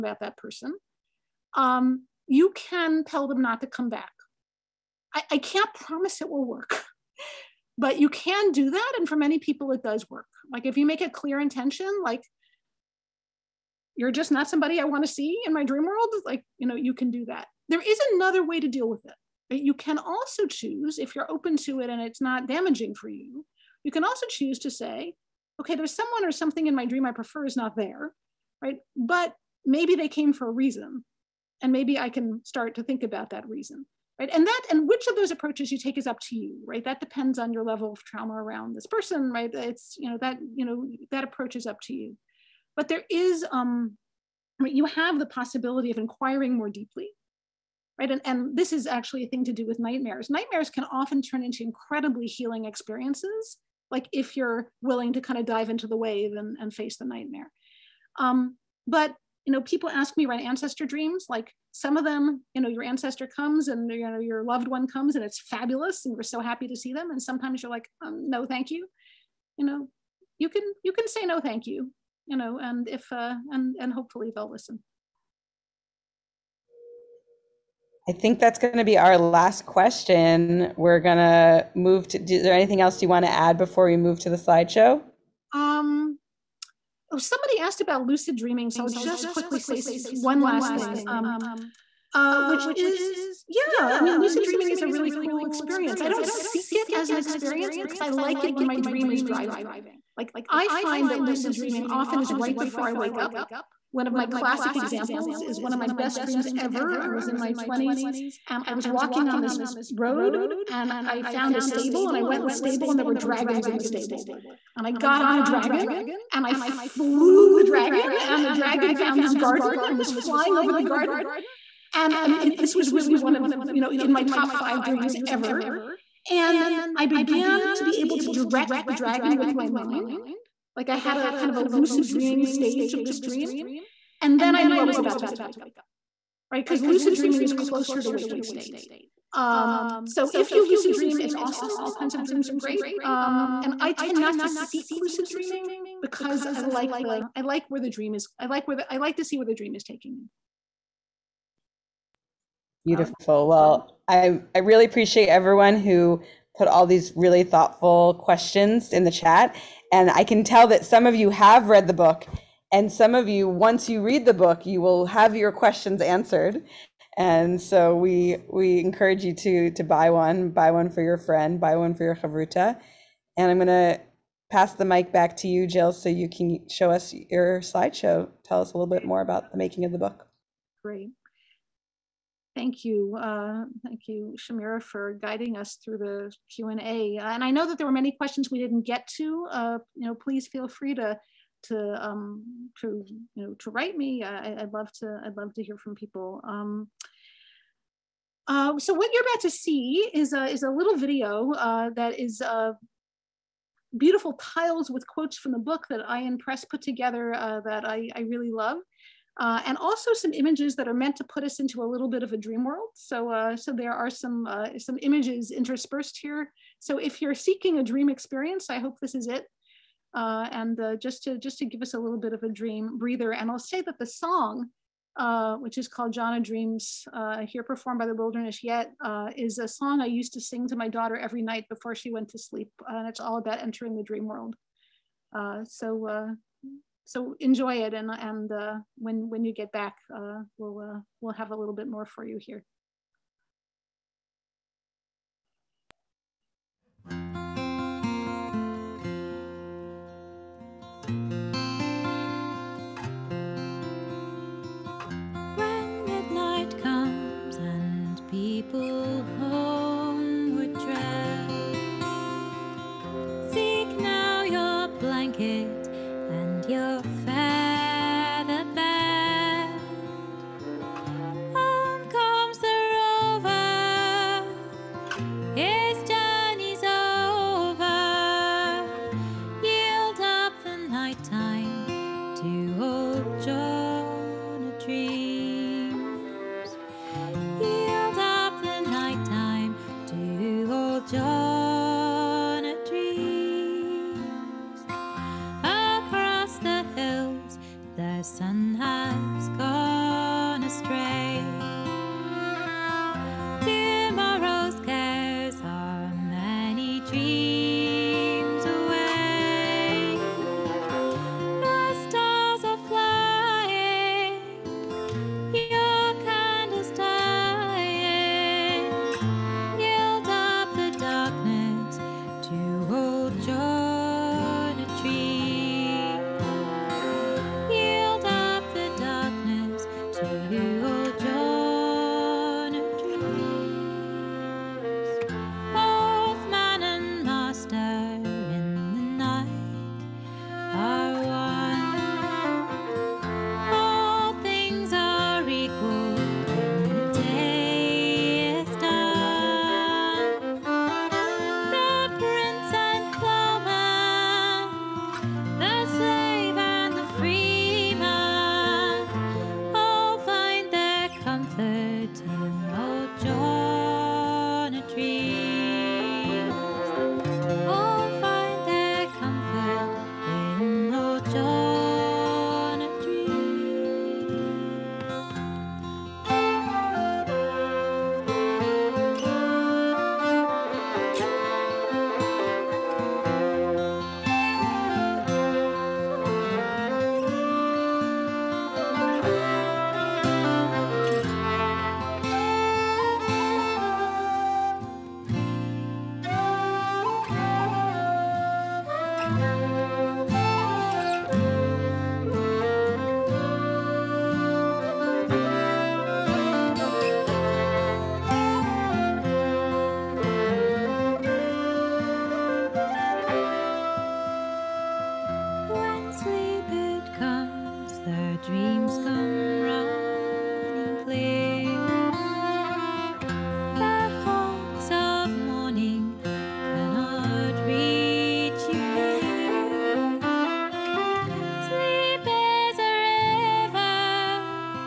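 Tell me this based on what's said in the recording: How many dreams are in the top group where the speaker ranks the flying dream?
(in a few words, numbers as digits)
5.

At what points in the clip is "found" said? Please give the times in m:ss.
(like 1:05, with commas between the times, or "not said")
1:51, 1:58.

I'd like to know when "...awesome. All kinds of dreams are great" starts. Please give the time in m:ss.
2:21.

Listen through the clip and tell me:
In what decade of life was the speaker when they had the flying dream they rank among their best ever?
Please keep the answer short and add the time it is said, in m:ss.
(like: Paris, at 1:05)
20s, at 1:47.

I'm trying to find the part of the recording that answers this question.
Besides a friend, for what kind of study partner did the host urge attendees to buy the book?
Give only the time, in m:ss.
2:52.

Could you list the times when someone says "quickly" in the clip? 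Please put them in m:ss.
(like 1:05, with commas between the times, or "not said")
1:29.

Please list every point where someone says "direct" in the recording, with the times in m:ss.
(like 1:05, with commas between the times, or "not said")
2:08.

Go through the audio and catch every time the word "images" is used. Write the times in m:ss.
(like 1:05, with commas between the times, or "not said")
3:30, 3:35.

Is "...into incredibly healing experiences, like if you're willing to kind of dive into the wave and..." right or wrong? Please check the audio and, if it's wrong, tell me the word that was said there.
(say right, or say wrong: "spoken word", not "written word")
right.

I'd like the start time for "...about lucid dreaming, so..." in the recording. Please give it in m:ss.
1:27.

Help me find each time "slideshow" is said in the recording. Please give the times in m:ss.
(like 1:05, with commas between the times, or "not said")
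1:24, 2:57.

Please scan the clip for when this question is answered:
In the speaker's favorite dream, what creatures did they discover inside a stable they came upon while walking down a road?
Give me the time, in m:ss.
1:53.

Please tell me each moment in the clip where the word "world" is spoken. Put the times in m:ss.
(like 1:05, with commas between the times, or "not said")
0:15, 3:32, 3:54.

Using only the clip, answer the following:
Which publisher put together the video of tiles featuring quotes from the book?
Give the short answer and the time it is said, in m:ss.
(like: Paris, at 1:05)
Ayin Press, at 3:26.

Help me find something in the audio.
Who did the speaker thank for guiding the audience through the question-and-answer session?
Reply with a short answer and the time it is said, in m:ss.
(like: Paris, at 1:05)
Shamira, at 3:04.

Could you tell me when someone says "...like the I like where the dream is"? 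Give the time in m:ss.
2:26.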